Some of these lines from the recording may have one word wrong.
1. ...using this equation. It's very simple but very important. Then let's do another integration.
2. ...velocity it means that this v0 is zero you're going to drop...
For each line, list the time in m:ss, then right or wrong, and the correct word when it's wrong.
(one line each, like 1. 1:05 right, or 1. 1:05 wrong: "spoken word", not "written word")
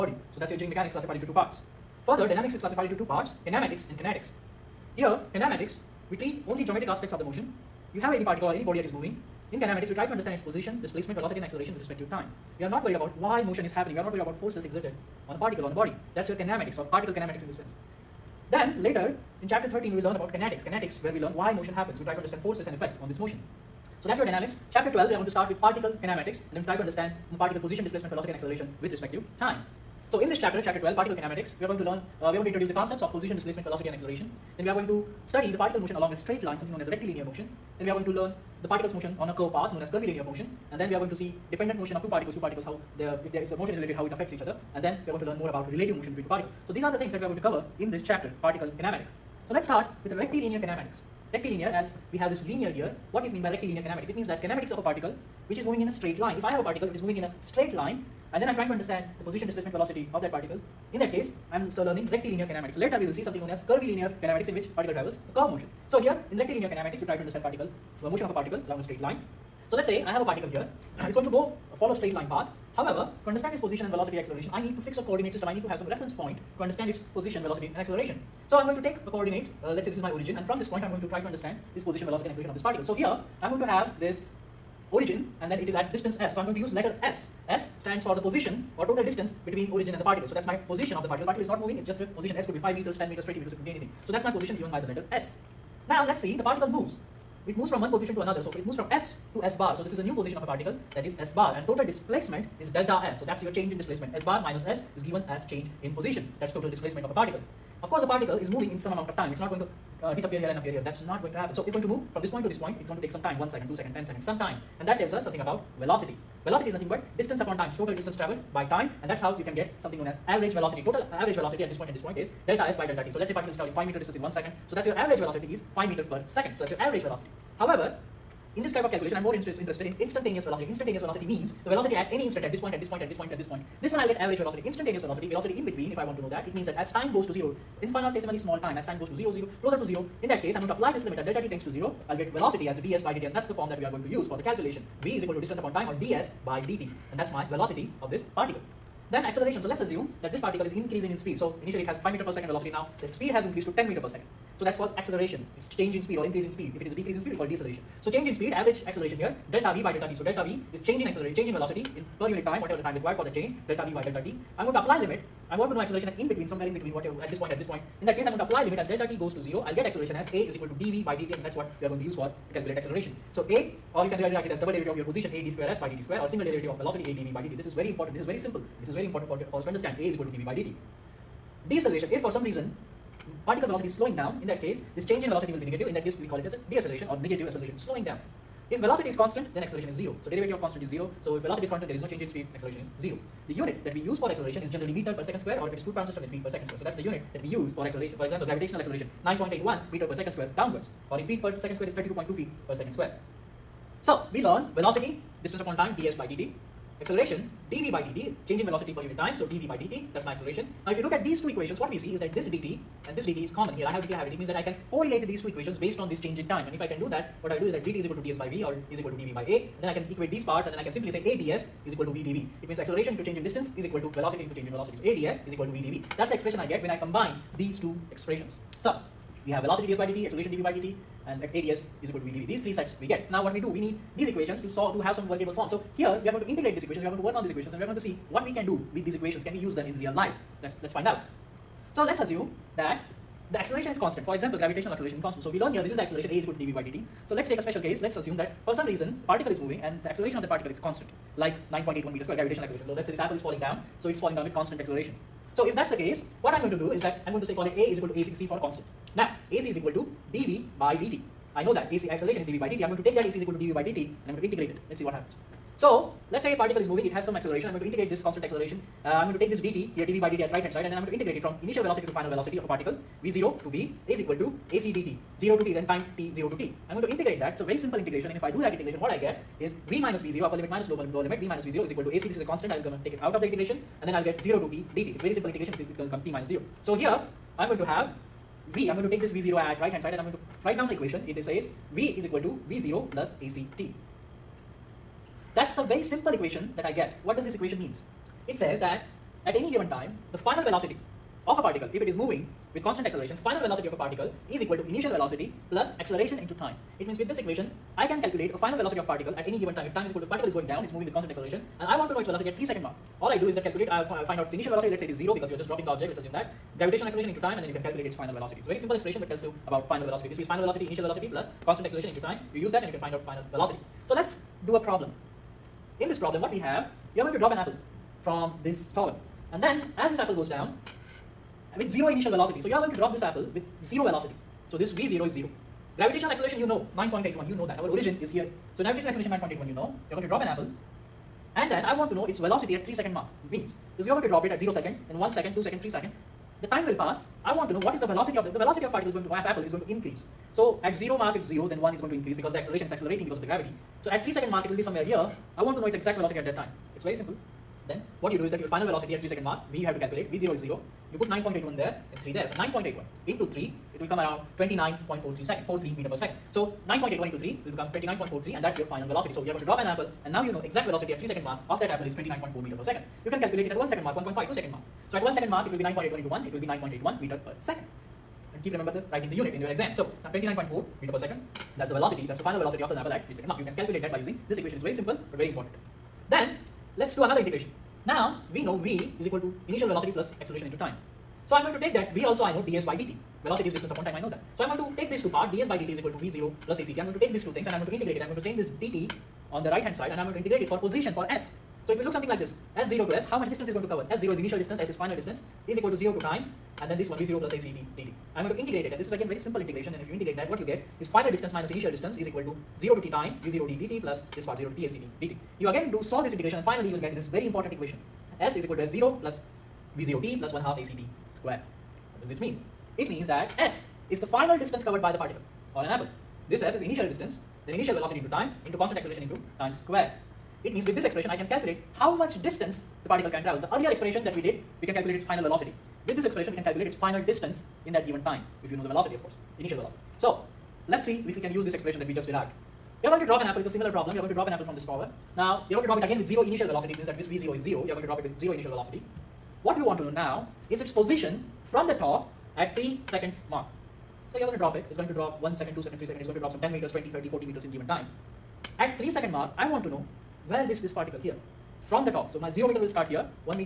1. 6:24 right
2. 7:26 right.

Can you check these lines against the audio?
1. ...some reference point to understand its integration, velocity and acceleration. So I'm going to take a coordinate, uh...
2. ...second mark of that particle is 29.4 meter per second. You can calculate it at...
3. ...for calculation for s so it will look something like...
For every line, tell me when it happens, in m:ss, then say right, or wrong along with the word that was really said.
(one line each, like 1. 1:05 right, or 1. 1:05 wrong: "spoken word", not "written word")
1. 1:15 wrong: "position", not "integration"
2. 6:11 wrong: "apple", not "particle"
3. 6:40 wrong: "position", not "calculation".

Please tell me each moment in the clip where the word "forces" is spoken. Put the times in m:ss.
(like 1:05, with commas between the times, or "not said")
0:14, 0:22.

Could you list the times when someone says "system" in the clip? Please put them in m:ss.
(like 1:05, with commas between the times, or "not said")
1:15, 3:16.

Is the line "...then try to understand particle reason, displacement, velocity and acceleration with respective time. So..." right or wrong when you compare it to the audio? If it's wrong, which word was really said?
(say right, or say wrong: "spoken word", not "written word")
wrong: "position", not "reason".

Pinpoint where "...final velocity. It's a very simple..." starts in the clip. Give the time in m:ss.
5:18.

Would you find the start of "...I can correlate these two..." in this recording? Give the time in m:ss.
3:34.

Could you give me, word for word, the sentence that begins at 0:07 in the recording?
You have any particle or any body that is moving.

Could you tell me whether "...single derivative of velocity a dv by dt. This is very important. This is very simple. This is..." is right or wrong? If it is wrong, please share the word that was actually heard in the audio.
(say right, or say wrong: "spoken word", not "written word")
right.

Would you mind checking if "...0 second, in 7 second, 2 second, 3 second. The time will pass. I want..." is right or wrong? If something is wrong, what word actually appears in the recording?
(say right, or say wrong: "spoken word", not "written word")
wrong: "1", not "7".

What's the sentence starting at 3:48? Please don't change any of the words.
So we have velocity ds by dt, acceleration dv by dt and ADS is equal to VDV.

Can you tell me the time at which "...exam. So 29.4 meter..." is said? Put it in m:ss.
6:19.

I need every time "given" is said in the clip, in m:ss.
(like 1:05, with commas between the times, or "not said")
1:34, 1:45, 4:59, 5:09, 7:18, 7:37.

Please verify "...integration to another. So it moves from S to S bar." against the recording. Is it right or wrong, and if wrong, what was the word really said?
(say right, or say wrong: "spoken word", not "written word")
wrong: "position", not "integration".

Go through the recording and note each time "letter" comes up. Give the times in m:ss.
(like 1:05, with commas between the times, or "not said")
1:26, 1:34.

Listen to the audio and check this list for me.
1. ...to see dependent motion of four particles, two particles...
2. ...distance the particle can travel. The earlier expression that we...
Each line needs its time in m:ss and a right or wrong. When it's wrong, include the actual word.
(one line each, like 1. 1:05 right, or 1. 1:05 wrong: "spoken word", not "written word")
1. 0:41 wrong: "two", not "four"
2. 7:12 right.